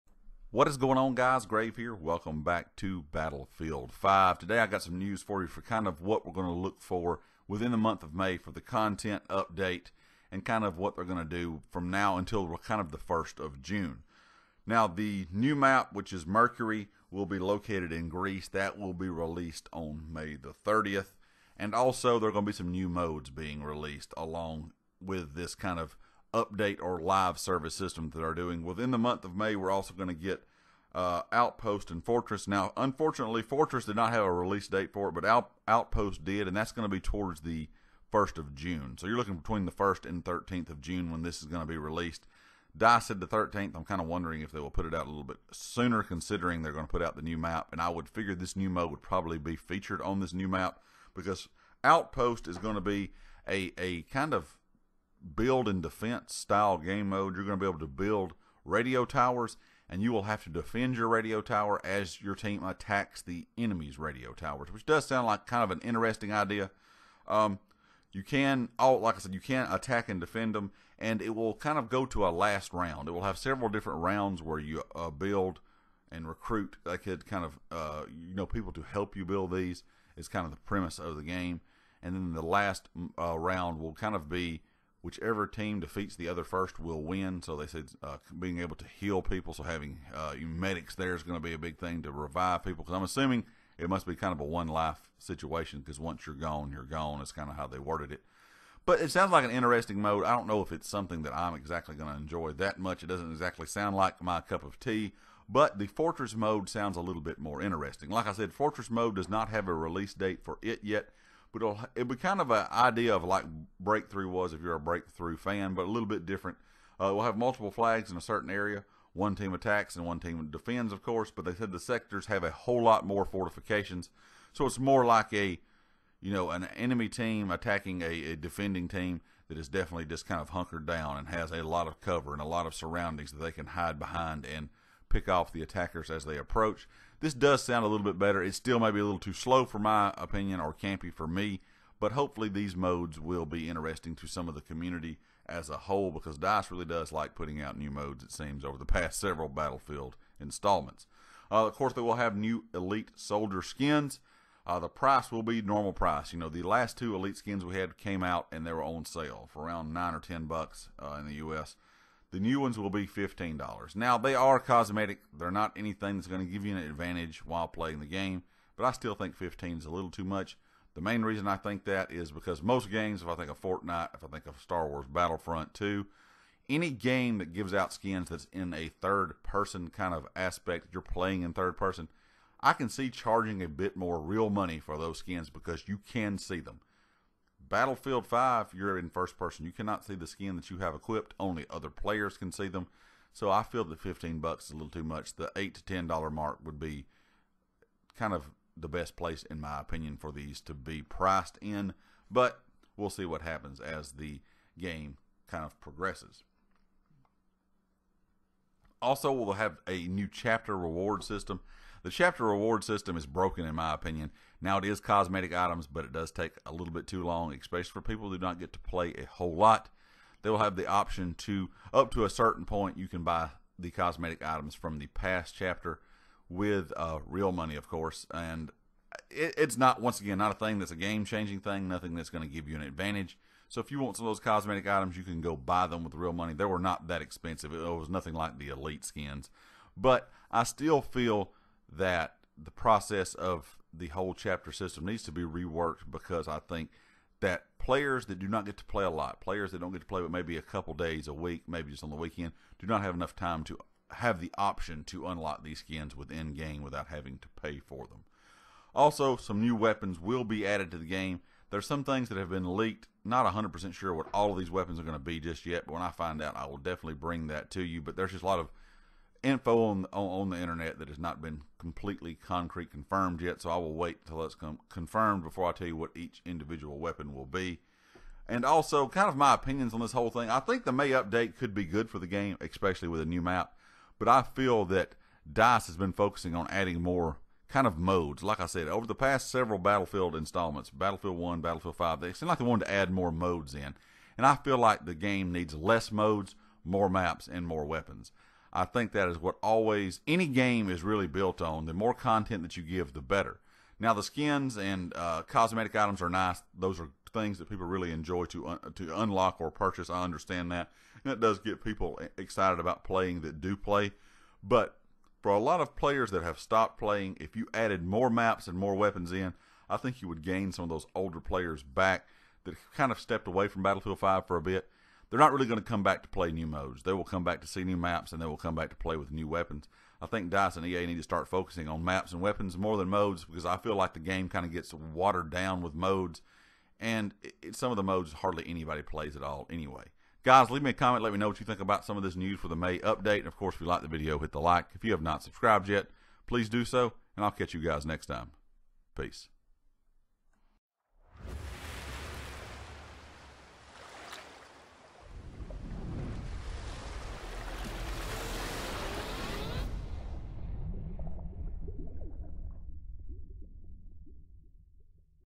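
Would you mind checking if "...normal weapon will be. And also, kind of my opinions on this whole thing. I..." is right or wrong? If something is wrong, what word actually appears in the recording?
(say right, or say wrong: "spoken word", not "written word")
wrong: "individual", not "normal".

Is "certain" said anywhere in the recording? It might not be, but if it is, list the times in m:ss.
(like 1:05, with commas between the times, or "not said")
1:58, 3:42.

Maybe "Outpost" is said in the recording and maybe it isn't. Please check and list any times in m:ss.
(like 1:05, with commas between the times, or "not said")
0:31, 0:35, 0:51.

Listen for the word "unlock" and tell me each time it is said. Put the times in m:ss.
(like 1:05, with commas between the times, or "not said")
4:15, 5:09.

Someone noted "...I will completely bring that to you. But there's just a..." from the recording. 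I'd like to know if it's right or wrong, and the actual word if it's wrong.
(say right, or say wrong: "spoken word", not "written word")
wrong: "definitely", not "completely".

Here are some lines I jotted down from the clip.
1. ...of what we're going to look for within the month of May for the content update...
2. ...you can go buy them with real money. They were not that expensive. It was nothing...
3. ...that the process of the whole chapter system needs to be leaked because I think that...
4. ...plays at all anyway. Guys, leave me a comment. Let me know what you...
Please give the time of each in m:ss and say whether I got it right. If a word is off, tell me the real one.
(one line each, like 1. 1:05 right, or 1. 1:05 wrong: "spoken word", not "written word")
1. 0:05 right
2. 3:55 right
3. 4:01 wrong: "reworked", not "leaked"
4. 5:39 right.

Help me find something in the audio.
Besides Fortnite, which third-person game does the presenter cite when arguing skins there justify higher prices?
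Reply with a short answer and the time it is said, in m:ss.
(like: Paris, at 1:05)
Star Wars Battlefront 2, at 2:54.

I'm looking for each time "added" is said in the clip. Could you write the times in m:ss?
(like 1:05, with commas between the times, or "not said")
4:20, 5:17.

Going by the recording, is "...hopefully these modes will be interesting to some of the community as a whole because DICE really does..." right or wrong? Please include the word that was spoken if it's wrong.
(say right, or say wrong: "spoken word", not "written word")
right.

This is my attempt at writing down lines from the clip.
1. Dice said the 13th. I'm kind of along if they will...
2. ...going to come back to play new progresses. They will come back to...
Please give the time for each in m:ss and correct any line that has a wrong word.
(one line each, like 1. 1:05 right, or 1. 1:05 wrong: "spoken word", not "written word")
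1. 0:42 wrong: "wondering", not "along"
2. 5:25 wrong: "modes", not "progresses".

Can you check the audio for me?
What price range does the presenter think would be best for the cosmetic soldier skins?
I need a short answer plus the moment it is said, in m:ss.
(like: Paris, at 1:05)
$8 to $10, at 3:15.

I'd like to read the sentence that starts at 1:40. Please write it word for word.
I don't know if it's something that I'm exactly going to enjoy that much.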